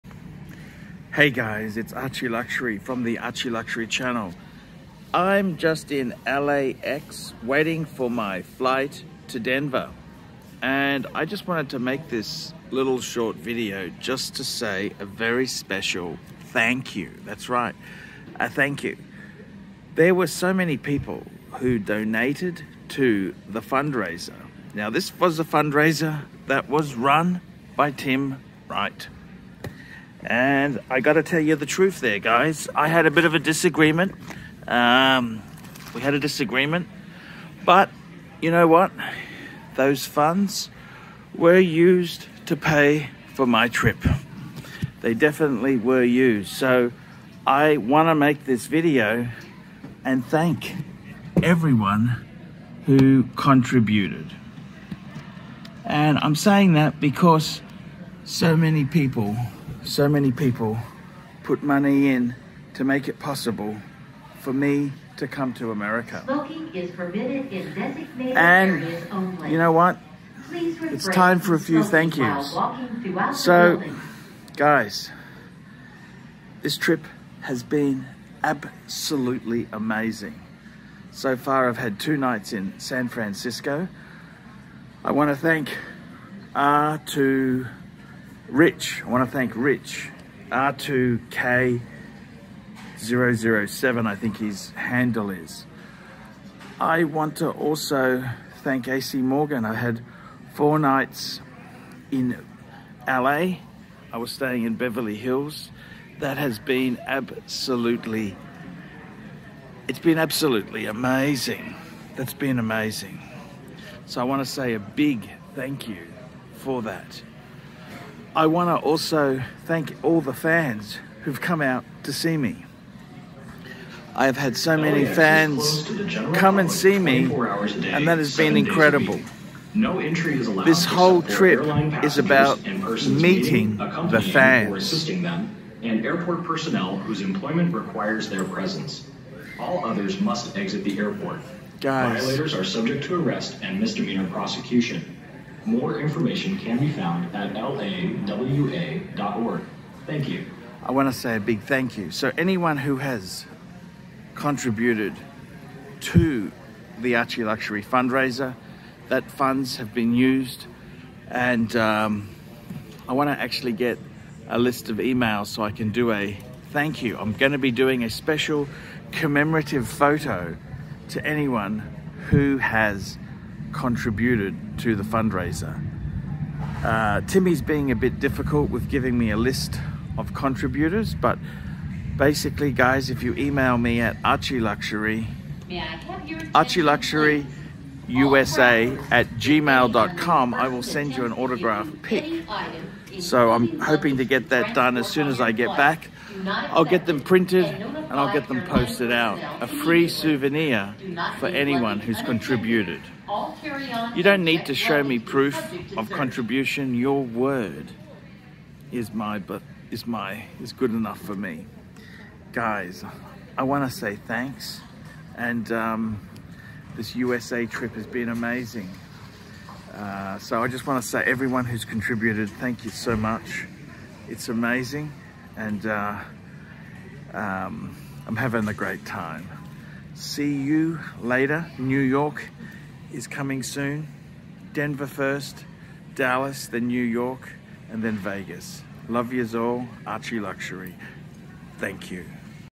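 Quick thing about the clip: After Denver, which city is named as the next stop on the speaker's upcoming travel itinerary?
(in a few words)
Dallas.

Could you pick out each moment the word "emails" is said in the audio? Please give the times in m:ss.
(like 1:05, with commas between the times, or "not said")
2:44, 3:03.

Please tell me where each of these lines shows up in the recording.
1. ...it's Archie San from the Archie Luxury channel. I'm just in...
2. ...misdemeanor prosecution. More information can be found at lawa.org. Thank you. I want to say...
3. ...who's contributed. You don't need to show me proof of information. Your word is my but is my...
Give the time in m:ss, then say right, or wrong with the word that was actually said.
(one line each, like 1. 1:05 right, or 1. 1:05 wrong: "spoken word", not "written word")
1. 0:01 wrong: "Luxury", not "San"
2. 2:23 right
3. 3:21 wrong: "contribution", not "information".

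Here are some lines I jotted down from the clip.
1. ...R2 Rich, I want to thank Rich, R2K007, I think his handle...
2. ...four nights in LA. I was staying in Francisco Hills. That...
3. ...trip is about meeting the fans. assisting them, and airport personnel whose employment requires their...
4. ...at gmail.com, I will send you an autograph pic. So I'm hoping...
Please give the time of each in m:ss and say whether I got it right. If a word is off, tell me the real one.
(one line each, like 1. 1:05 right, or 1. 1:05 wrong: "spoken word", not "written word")
1. 1:26 right
2. 1:40 wrong: "Beverly", not "Francisco"
3. 2:11 right
4. 3:09 right.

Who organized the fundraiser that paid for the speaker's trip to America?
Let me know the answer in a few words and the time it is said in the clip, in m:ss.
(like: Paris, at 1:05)
Tim Wright, at 0:27.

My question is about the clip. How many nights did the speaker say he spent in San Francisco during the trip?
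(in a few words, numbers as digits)
2.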